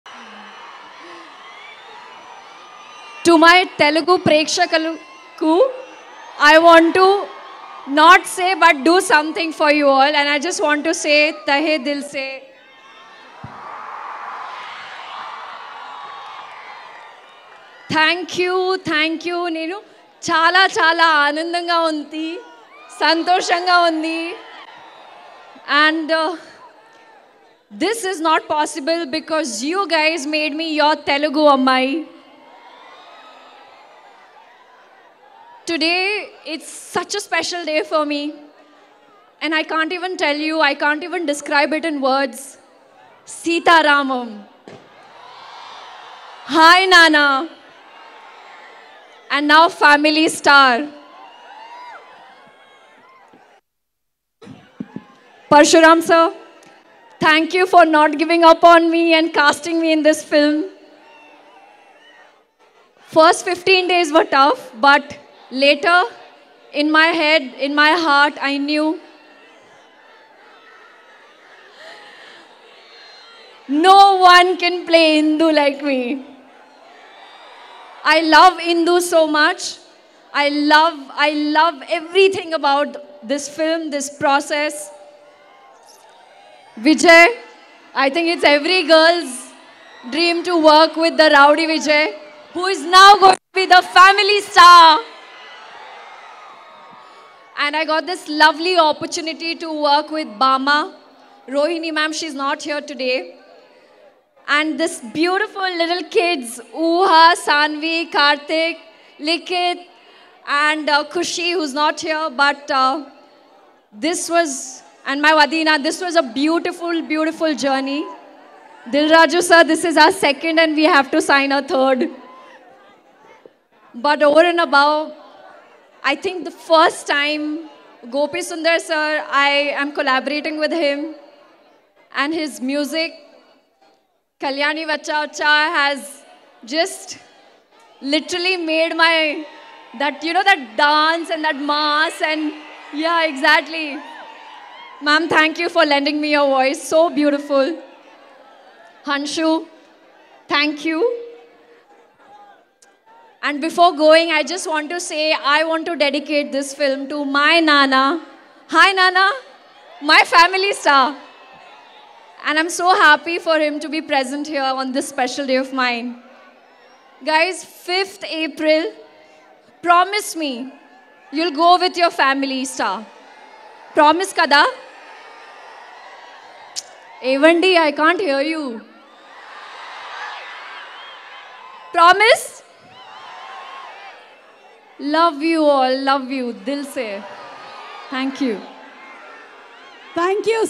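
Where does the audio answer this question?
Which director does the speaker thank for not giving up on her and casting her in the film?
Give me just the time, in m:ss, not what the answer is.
0:55.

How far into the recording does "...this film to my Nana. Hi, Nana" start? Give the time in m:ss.
2:36.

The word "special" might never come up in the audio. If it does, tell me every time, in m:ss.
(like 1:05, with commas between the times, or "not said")
0:37, 2:45.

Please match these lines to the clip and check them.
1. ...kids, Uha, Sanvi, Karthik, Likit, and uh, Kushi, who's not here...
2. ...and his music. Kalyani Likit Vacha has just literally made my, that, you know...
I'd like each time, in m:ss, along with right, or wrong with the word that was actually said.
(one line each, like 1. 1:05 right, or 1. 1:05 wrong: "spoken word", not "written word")
1. 1:46 right
2. 2:12 wrong: "Vacha", not "Likit".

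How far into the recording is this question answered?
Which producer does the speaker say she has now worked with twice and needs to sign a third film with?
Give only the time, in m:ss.
1:58.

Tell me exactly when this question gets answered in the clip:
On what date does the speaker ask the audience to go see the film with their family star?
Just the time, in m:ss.
2:47.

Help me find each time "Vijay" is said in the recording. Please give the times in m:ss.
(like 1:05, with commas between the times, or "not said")
1:26, 1:31.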